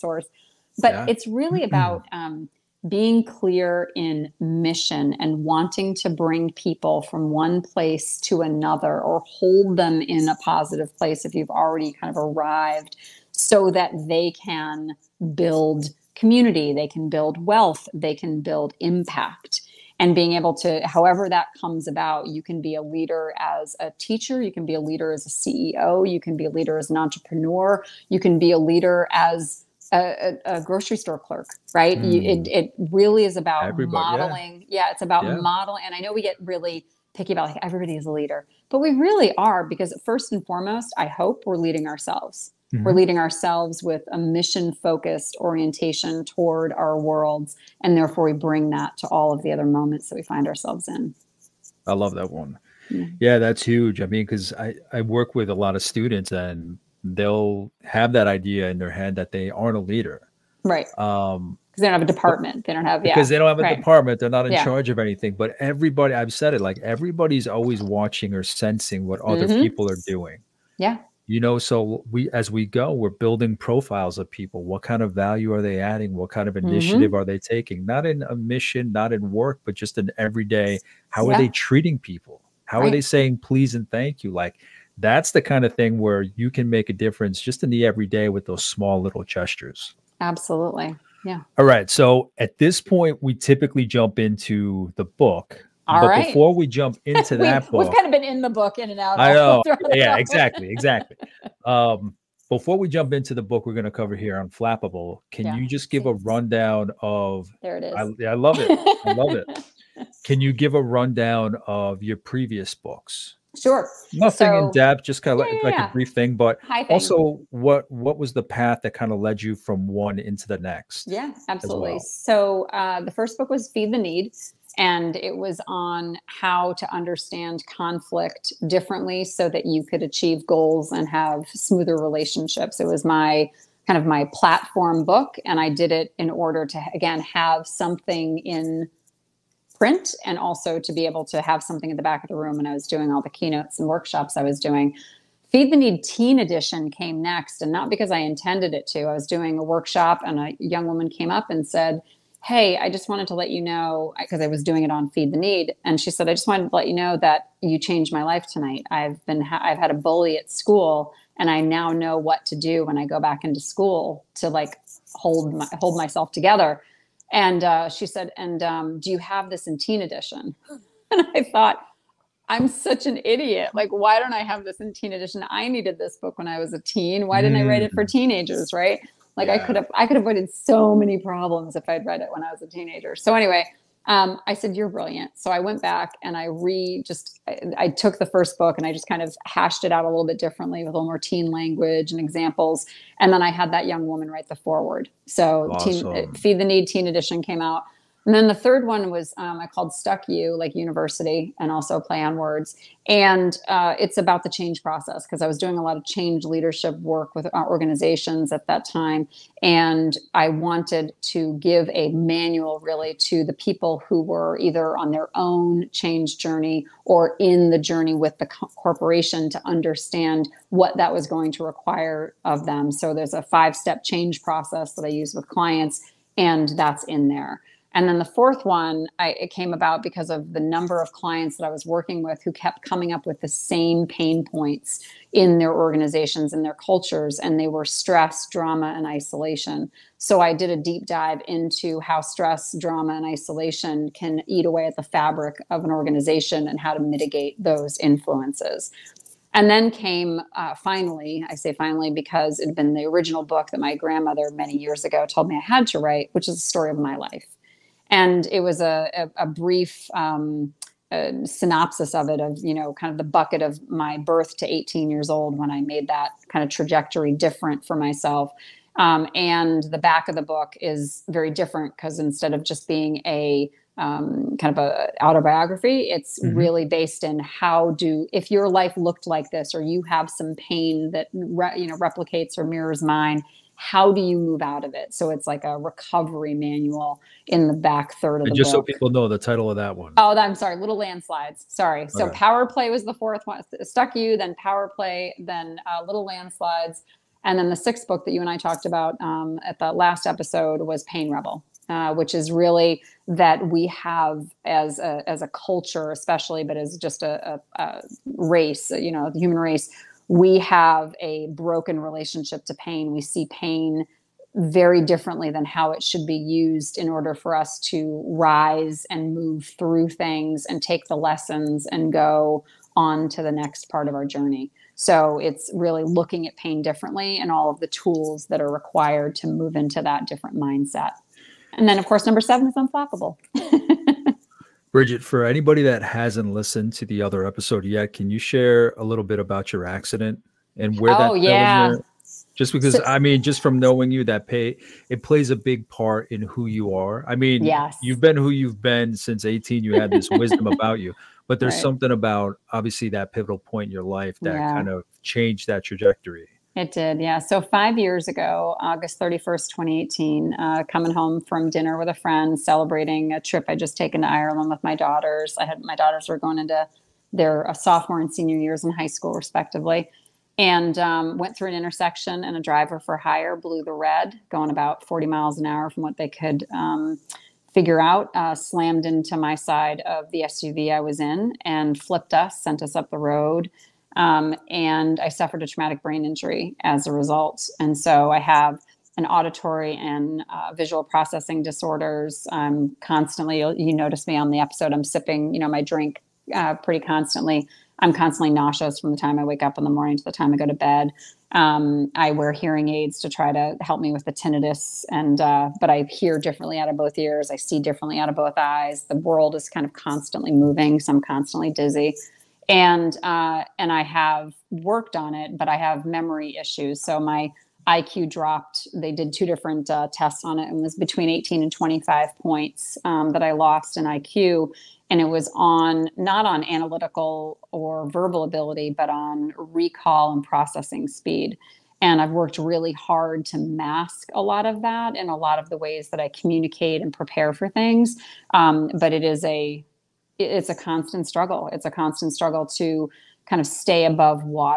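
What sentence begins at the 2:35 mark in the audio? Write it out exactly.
And she said, I just wanted to let you know that you changed my life tonight.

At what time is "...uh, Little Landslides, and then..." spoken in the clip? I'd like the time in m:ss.
4:55.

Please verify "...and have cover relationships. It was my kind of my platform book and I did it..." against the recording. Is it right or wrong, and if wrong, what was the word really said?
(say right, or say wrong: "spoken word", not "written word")
wrong: "smoother", not "cover".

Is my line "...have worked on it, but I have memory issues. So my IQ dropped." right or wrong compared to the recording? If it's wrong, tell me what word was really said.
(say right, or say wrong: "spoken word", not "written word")
right.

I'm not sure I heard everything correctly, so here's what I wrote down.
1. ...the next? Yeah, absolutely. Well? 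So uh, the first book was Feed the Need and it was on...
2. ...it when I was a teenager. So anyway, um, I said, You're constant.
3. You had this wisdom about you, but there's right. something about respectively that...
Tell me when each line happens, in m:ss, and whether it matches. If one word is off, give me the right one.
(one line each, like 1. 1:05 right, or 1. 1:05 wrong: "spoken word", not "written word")
1. 2:00 right
2. 3:02 wrong: "brilliant", not "constant"
3. 5:49 wrong: "obviously", not "respectively".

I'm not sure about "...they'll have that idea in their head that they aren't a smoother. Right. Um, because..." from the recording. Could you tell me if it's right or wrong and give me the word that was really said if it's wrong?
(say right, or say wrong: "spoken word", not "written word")
wrong: "leader", not "smoother".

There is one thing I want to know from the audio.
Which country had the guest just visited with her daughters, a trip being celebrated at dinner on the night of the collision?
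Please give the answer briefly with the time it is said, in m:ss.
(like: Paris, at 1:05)
Ireland, at 6:04.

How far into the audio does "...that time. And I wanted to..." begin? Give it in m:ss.
3:28.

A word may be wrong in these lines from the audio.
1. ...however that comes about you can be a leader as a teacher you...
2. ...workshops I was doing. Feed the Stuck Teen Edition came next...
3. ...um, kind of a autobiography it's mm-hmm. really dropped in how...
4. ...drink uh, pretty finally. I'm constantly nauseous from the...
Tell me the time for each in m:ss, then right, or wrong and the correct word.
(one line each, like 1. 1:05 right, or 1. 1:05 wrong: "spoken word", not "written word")
1. 0:20 right
2. 2:23 wrong: "Need", not "Stuck"
3. 4:33 wrong: "based", not "dropped"
4. 6:35 wrong: "constantly", not "finally".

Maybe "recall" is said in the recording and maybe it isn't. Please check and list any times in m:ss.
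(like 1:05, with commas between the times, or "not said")
7:09.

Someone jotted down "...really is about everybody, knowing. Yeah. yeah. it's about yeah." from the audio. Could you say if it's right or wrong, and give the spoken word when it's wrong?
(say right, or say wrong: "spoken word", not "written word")
wrong: "modeling", not "knowing".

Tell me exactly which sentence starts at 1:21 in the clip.
are they treating people how right.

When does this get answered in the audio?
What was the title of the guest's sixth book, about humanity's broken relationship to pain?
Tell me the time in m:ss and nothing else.
5:01.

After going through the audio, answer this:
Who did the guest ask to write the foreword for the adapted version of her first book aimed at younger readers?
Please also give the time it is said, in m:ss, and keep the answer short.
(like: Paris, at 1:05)
That young woman, at 3:13.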